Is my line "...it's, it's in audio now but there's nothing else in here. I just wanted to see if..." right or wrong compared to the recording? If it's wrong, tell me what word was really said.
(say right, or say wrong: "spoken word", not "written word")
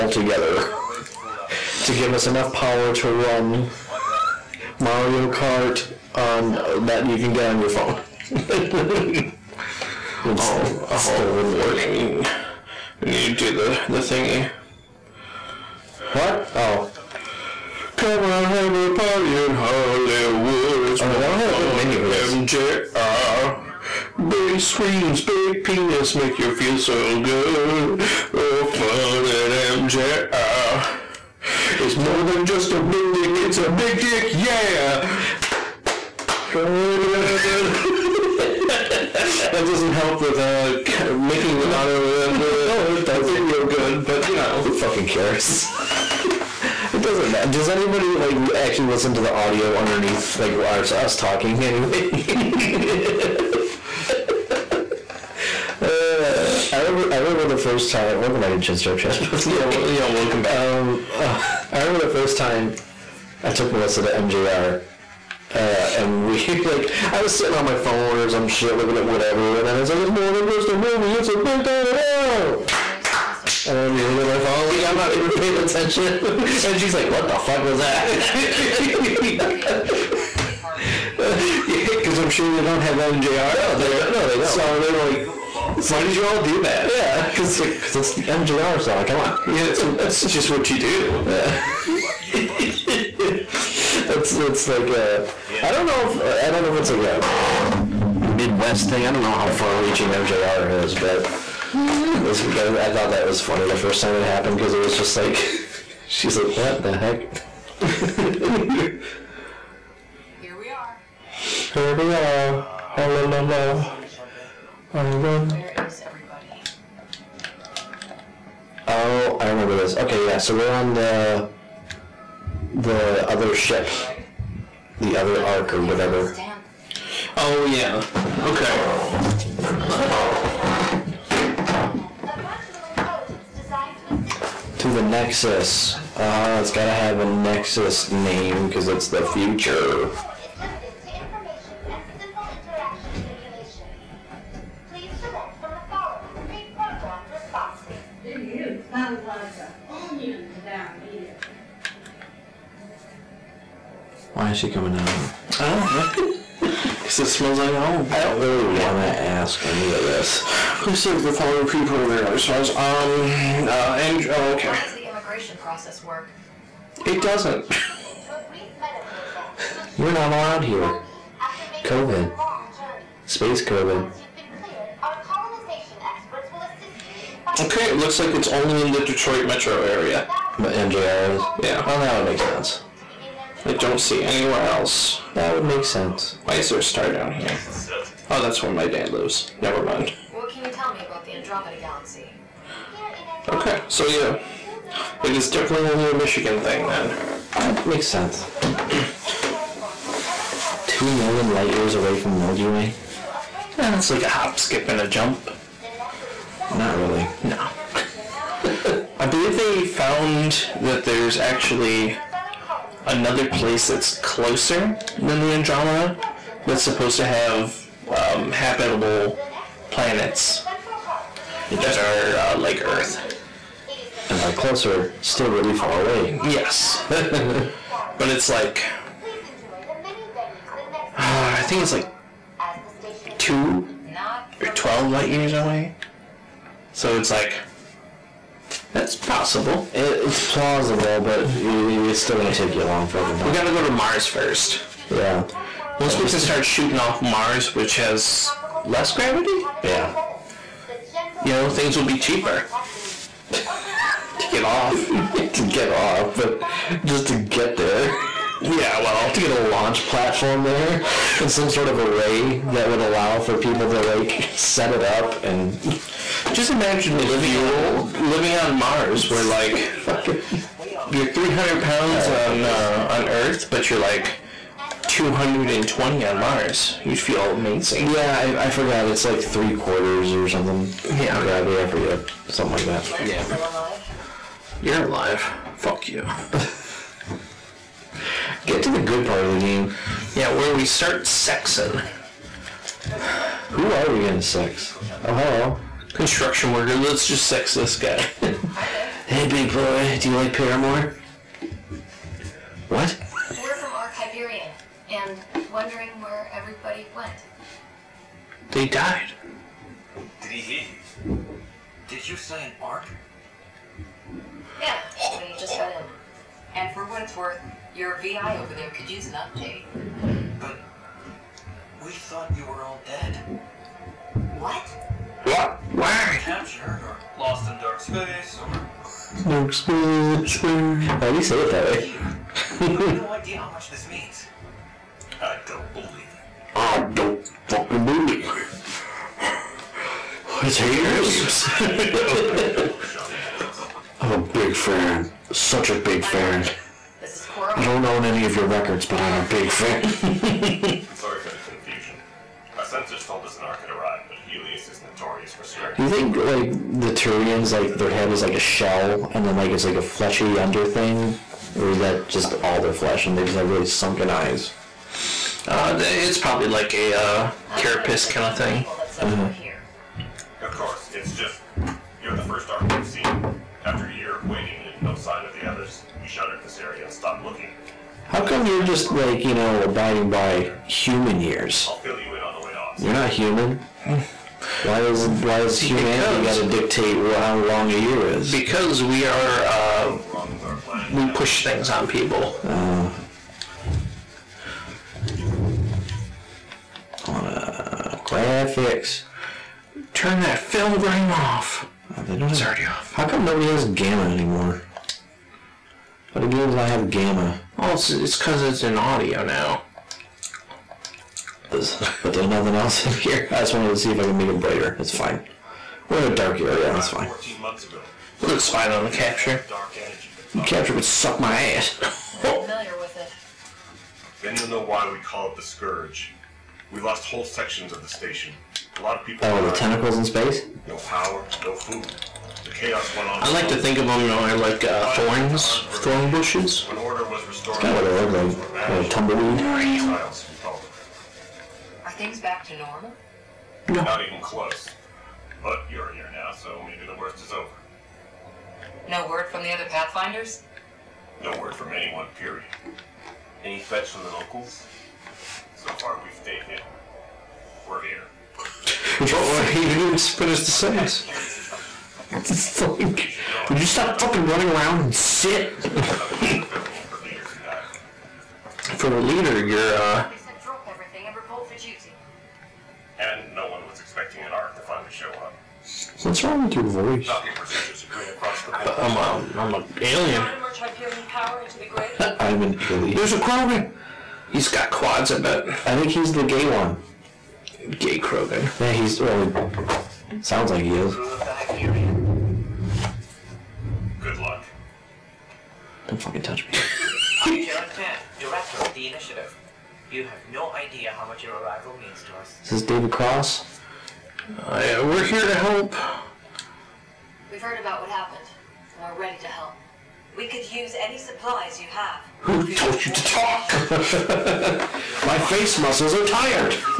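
right.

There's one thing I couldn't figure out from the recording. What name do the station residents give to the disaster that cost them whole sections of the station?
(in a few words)
the Scourge.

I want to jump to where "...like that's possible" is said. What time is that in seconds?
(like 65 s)
237 s.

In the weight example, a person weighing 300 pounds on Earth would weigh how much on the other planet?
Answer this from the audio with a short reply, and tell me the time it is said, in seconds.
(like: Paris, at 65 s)
220, at 275 s.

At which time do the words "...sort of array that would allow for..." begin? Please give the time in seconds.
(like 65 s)
261 s.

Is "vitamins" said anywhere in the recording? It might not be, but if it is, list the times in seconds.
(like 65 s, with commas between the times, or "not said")
not said.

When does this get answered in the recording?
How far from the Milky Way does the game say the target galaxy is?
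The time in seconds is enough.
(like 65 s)
200 s.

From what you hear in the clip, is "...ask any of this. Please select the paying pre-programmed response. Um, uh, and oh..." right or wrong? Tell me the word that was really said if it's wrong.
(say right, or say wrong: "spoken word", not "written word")
wrong: "following", not "paying".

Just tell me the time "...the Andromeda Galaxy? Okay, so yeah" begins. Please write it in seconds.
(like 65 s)
191 s.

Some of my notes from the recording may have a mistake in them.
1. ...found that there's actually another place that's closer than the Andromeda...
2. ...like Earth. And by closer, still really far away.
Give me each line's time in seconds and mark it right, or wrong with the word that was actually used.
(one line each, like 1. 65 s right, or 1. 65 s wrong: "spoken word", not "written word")
1. 209 s right
2. 222 s right.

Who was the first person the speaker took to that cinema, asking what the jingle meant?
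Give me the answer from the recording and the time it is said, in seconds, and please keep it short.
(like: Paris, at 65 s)
Melissa, at 63 s.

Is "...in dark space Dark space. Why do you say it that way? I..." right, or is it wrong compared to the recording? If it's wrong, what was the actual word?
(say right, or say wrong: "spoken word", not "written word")
right.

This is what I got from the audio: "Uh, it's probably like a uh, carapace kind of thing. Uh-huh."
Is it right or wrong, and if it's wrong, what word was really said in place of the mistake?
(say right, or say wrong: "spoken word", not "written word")
right.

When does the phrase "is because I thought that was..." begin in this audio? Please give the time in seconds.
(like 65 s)
102 s.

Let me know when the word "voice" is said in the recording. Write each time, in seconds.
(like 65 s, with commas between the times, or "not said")
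476 s.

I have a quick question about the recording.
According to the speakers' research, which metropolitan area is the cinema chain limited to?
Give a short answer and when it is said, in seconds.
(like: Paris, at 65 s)
Detroit, at 179 s.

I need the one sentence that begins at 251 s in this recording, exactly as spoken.
You know, things will be cheaper.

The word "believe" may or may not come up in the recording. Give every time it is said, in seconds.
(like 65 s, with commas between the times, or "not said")
209 s, 338 s.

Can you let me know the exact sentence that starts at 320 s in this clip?
But we thought you were all dead.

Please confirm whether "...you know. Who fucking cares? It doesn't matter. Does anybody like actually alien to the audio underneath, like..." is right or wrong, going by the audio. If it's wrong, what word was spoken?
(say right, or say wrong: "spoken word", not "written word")
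wrong: "listen", not "alien".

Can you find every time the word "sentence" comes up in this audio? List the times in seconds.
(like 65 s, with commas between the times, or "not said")
460 s.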